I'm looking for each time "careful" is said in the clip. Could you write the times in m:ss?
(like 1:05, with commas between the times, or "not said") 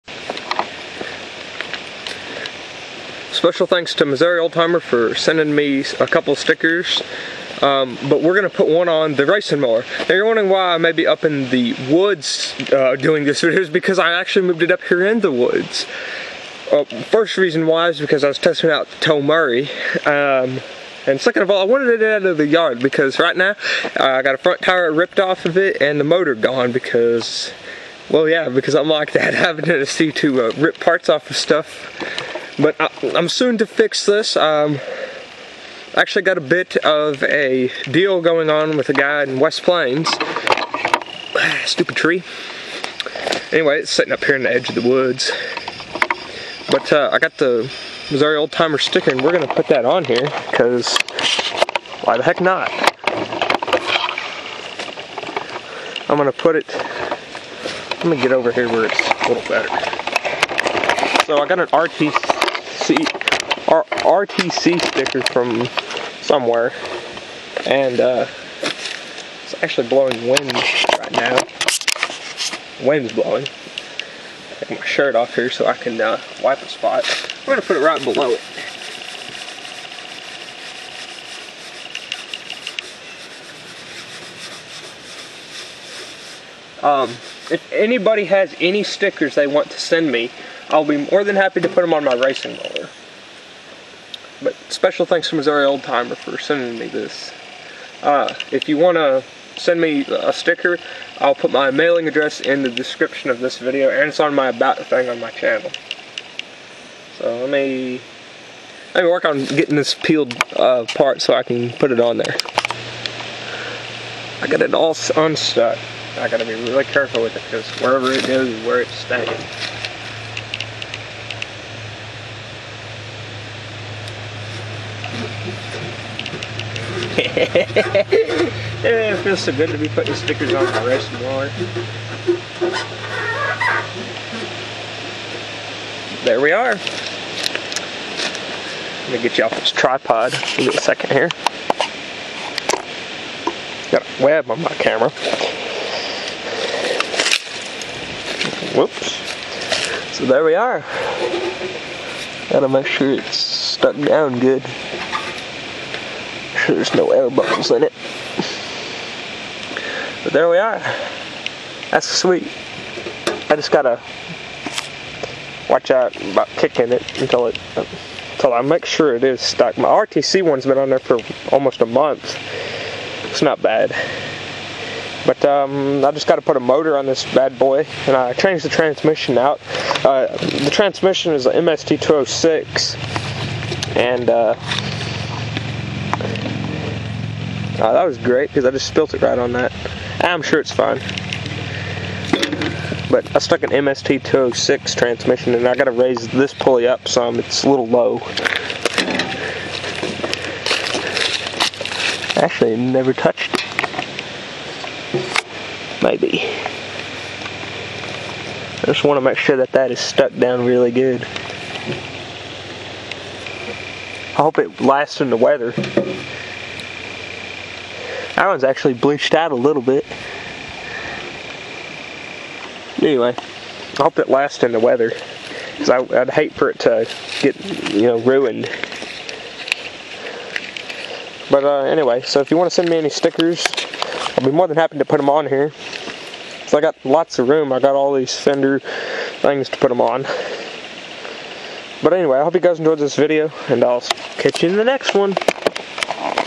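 1:56.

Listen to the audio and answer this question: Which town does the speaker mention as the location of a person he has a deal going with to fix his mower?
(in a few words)
West Plains.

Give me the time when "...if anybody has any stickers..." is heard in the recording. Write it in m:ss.
1:27.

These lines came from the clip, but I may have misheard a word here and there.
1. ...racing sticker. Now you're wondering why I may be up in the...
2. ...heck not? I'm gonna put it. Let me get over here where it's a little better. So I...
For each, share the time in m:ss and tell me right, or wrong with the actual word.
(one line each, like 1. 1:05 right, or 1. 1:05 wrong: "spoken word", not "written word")
1. 0:09 wrong: "mower", not "sticker"
2. 0:52 right.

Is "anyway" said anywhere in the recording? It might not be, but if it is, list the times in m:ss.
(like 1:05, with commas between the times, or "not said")
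0:43, 3:42, 3:51, 4:02.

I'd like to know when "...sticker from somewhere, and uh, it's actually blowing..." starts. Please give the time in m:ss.
1:04.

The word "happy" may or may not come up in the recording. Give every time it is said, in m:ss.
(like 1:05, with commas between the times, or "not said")
1:31, 3:54.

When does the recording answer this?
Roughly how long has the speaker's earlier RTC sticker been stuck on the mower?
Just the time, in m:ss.
2:51.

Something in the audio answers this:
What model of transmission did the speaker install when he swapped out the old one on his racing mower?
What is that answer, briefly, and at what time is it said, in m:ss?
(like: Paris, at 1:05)
MST206, at 3:01.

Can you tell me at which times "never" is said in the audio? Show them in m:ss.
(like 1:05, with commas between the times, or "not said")
3:22.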